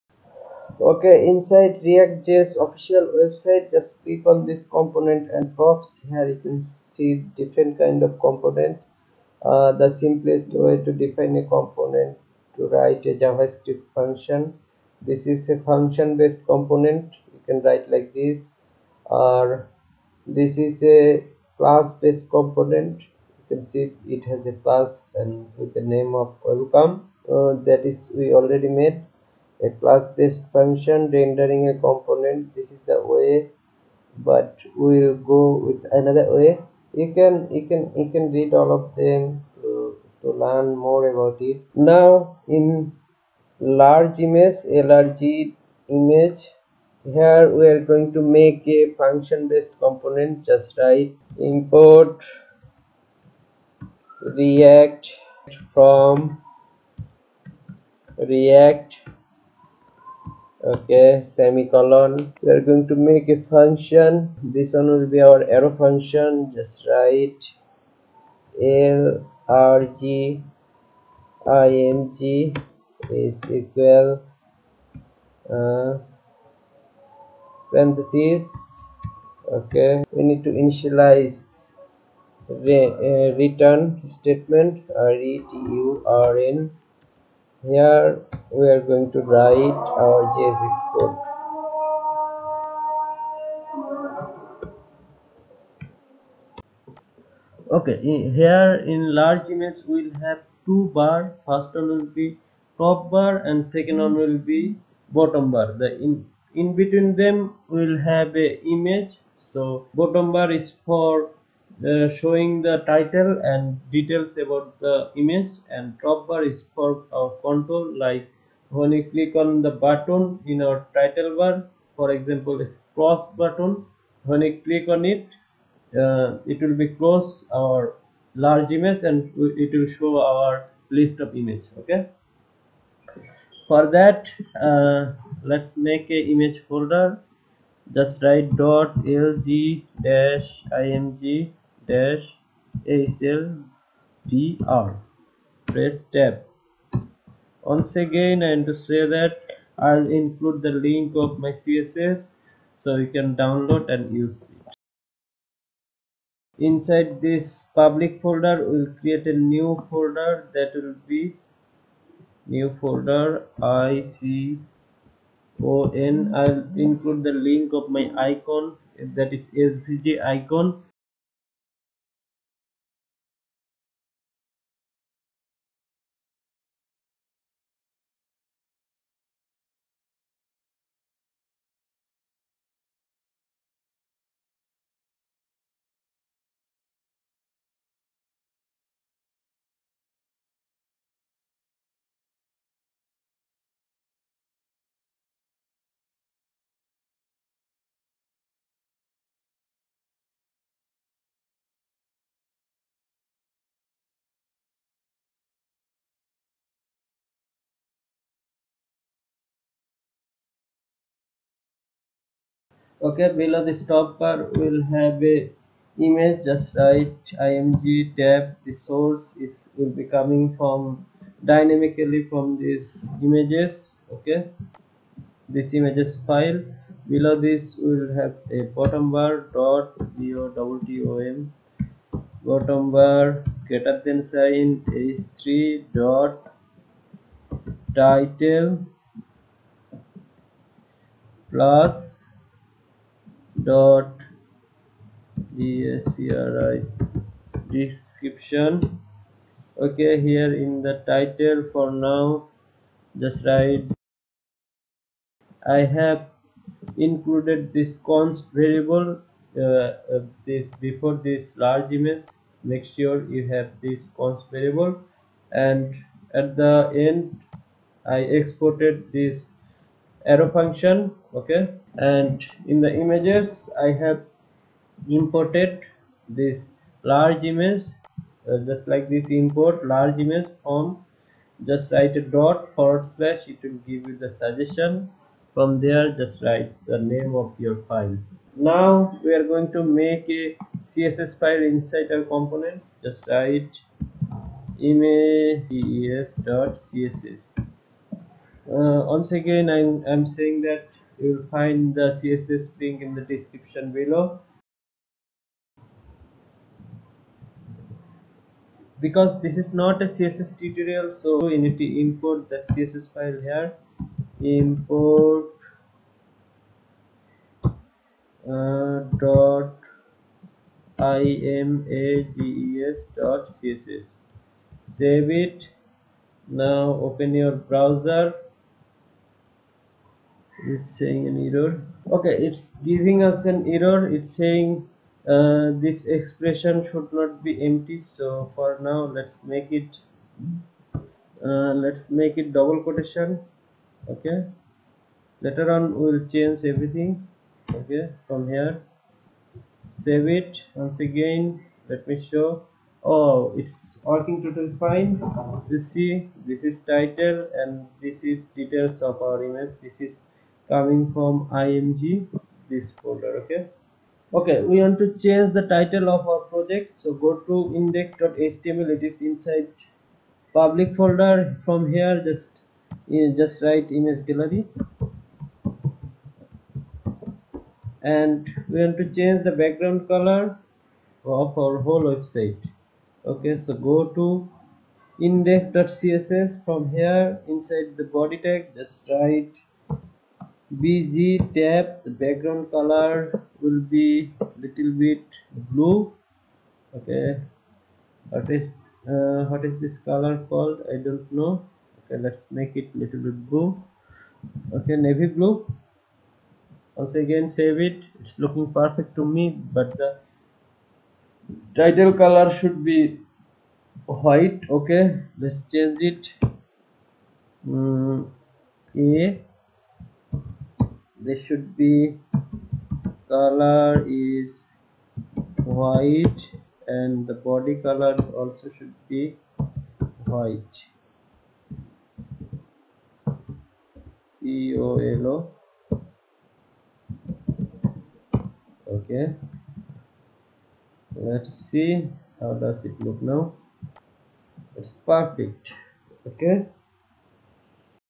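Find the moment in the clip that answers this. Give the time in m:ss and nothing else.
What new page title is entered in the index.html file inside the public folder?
6:13.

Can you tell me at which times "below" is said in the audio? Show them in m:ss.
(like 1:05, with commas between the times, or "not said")
3:33, 3:47, 5:03.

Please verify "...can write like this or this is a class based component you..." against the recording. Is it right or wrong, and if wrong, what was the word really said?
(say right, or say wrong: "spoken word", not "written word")
right.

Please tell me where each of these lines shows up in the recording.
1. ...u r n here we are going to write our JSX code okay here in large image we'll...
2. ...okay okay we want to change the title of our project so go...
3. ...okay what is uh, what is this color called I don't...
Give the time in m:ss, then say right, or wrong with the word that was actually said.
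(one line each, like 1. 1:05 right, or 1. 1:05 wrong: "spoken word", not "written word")
1. 1:25 right
2. 6:03 right
3. 6:36 right.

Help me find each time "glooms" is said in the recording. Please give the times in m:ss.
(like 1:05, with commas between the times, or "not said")
not said.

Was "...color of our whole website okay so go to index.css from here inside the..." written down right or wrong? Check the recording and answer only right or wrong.
right.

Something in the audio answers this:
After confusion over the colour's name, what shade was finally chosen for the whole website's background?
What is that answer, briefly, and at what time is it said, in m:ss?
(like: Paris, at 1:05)
Navy blue, at 6:44.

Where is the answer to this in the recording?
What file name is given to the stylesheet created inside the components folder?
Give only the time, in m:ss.
4:54.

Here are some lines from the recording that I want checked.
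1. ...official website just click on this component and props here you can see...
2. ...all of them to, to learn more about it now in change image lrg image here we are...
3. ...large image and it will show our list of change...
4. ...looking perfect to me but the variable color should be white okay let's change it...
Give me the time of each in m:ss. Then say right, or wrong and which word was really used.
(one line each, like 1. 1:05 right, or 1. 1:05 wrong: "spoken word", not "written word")
1. 0:02 right
2. 0:38 wrong: "large", not "change"
3. 2:08 wrong: "image", not "change"
4. 6:48 wrong: "title", not "variable".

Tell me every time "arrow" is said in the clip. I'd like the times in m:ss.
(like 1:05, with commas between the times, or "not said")
1:05, 4:30.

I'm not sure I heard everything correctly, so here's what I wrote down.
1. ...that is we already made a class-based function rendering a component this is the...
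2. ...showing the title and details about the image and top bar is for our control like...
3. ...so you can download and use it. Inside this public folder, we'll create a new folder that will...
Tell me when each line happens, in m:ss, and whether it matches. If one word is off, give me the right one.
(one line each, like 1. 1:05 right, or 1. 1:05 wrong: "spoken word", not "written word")
1. 0:27 right
2. 1:52 right
3. 2:32 right.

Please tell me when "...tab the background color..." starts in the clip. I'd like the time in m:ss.
6:31.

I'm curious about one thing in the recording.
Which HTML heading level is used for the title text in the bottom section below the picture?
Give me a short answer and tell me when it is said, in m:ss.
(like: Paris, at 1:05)
h3, at 3:55.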